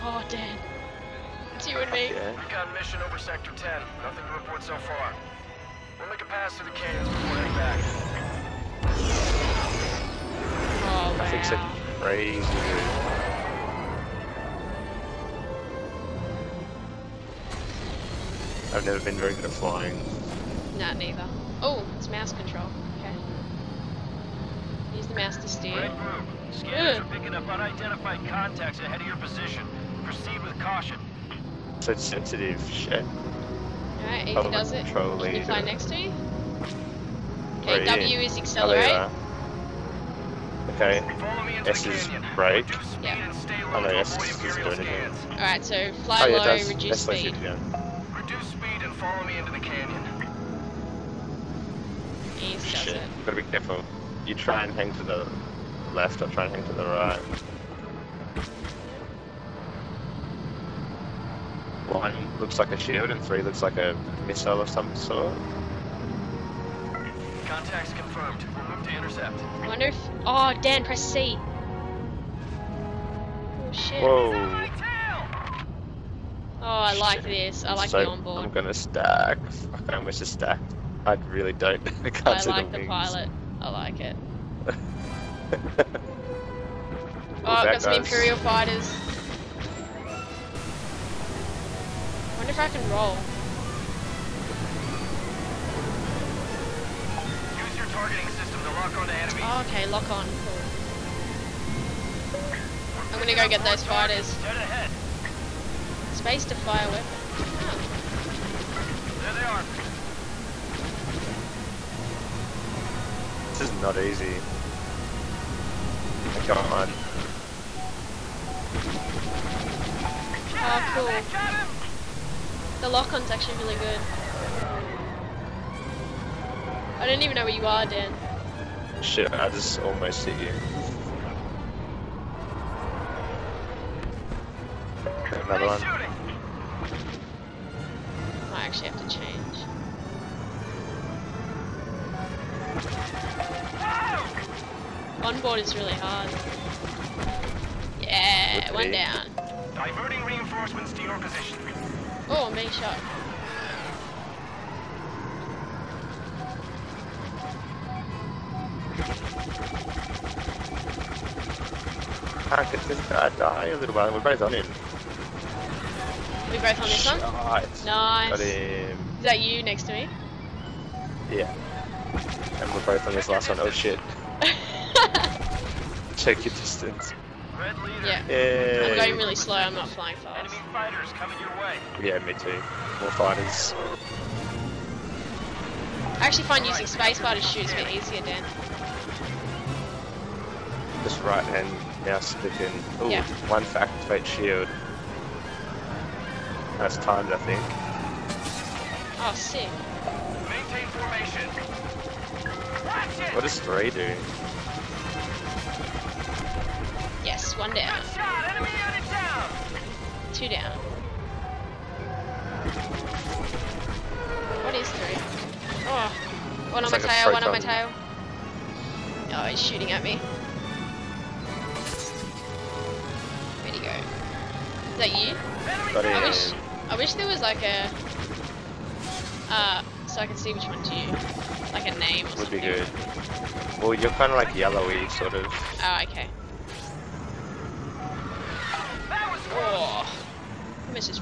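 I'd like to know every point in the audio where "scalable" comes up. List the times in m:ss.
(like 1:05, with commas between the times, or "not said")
not said.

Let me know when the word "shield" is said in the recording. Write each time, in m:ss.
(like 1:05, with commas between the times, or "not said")
1:02, 3:14.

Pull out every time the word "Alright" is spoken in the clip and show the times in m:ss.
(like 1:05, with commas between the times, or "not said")
0:34, 0:45.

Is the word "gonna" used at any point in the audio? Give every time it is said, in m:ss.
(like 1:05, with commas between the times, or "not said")
1:18, 1:43.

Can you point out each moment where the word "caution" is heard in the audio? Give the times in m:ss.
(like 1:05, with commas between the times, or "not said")
0:30.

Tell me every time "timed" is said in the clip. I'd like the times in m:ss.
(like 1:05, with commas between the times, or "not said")
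3:16.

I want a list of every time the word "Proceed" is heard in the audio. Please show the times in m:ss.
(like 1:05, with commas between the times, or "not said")
0:30.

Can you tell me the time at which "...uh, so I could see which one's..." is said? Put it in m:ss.
3:49.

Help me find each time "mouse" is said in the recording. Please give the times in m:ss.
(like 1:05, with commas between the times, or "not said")
0:22, 3:12.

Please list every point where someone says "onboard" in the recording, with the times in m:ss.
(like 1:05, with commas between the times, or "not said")
1:18, 2:25.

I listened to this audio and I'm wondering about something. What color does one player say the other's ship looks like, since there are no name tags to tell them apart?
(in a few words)
Yellowy.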